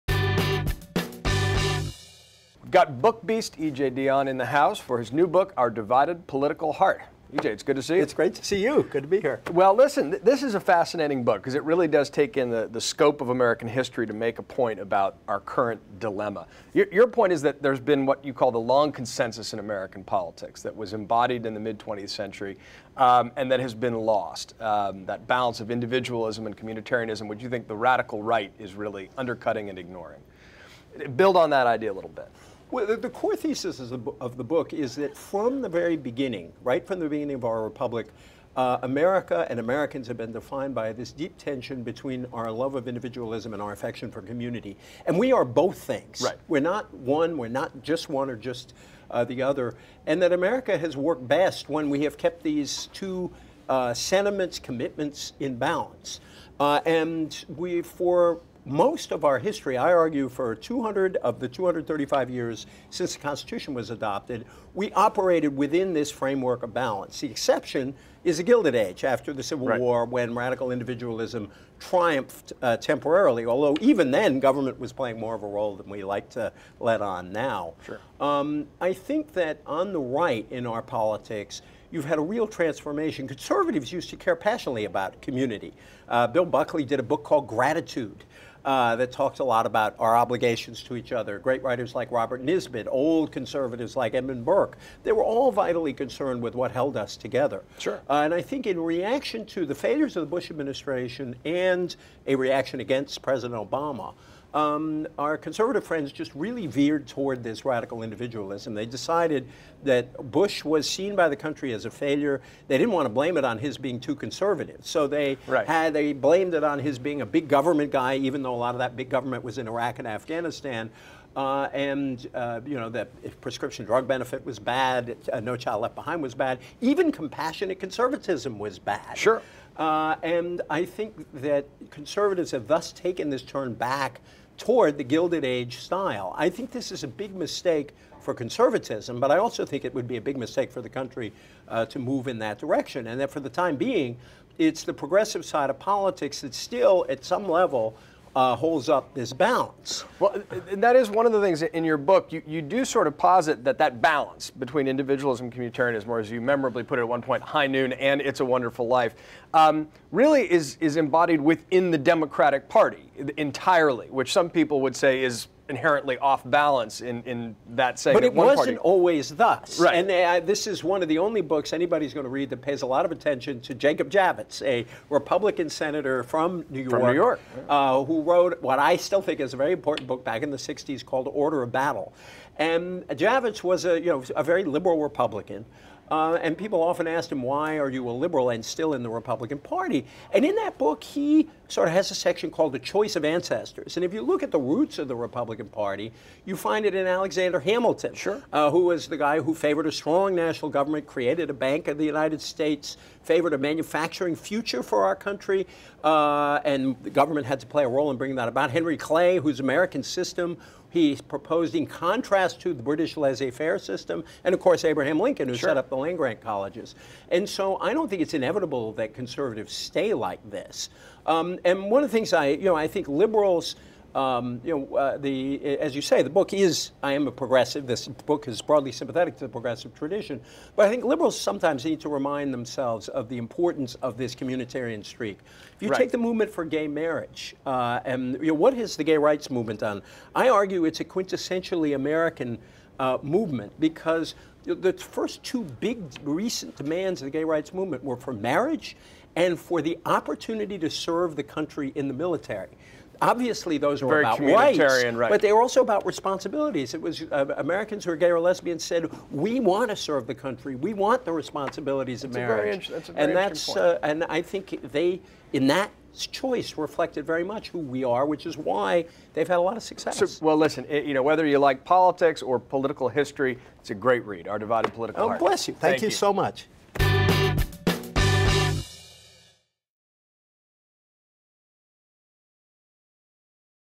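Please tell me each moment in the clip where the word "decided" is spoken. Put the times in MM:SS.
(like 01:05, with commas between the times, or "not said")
01:48.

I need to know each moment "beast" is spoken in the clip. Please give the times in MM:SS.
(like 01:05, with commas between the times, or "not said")
00:03.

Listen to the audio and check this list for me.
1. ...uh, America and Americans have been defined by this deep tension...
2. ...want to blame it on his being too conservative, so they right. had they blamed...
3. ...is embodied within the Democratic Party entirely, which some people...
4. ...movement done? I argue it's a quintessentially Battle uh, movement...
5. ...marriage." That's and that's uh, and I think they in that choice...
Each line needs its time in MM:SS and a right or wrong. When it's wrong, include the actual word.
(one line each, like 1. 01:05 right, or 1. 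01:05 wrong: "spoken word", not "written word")
1. 00:38 right
2. 01:52 right
3. 02:40 right
4. 03:59 wrong: "American", not "Battle"
5. 04:22 right.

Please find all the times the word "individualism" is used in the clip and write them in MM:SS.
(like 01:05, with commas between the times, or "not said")
00:25, 00:42, 01:10, 01:48, 02:34.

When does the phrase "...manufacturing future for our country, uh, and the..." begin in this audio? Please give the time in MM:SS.
03:23.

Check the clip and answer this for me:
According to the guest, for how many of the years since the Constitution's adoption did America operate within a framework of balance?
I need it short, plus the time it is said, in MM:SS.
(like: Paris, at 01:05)
200, at 01:00.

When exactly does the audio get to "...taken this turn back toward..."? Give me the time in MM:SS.
02:12.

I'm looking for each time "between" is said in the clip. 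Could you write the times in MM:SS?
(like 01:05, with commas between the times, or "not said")
00:41, 02:34.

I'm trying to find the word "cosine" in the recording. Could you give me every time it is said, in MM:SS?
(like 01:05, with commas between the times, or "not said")
not said.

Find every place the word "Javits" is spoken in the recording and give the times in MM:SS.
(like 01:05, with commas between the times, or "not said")
02:54, 03:03.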